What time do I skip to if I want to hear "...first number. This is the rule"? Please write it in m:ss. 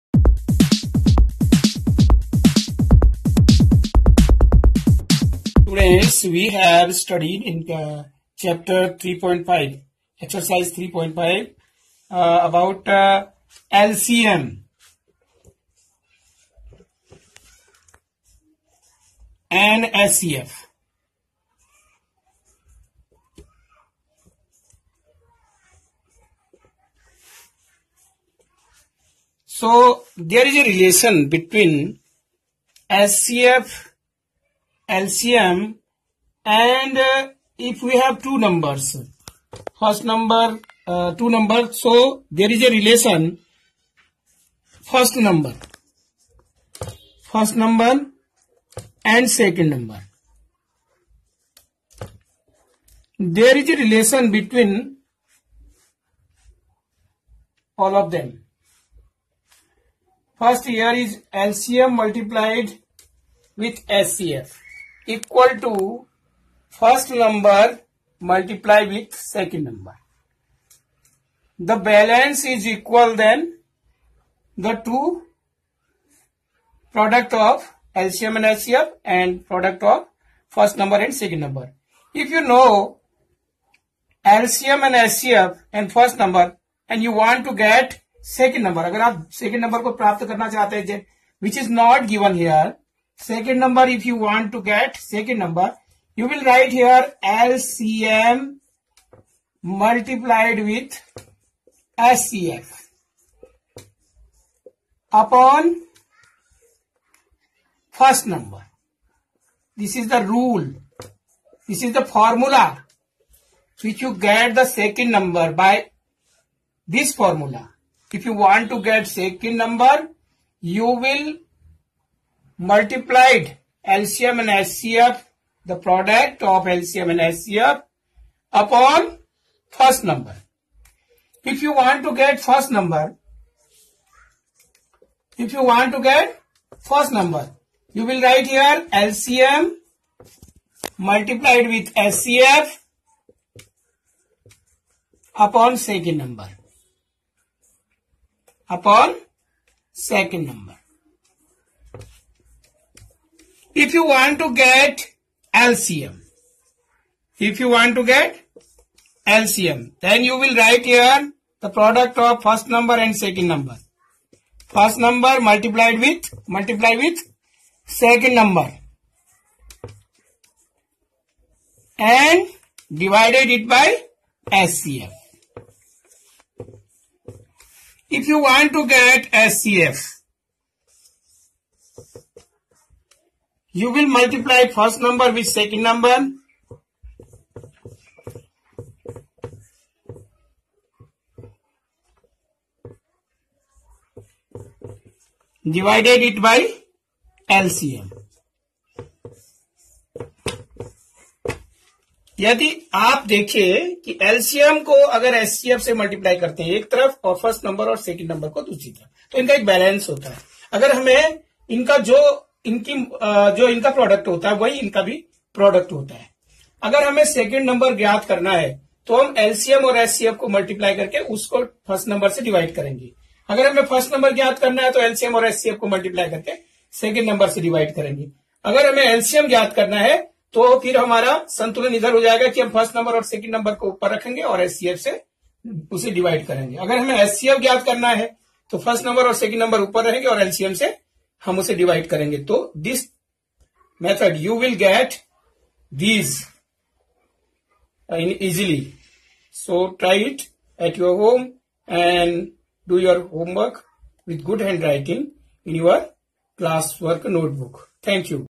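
1:47.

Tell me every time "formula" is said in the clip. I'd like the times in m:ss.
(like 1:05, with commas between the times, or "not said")
1:52, 1:57.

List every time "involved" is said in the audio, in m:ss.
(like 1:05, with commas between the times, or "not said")
not said.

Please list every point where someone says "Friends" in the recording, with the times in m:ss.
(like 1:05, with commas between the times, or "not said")
0:05.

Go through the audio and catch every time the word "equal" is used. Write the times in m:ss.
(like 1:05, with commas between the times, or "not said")
1:05, 1:12.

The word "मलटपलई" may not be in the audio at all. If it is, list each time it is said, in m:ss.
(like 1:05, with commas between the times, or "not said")
3:25, 3:40, 3:45.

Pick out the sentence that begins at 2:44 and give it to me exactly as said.
First number multiplied with, multiply with second number.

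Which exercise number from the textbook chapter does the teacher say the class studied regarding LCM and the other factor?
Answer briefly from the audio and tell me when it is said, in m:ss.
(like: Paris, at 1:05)
3.5, at 0:10.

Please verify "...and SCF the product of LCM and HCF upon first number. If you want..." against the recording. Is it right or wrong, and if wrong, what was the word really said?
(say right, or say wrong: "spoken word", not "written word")
wrong: "SCF", not "HCF".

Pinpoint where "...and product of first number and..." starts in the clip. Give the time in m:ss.
1:19.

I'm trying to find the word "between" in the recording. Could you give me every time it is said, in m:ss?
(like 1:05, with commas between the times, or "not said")
0:31, 0:54.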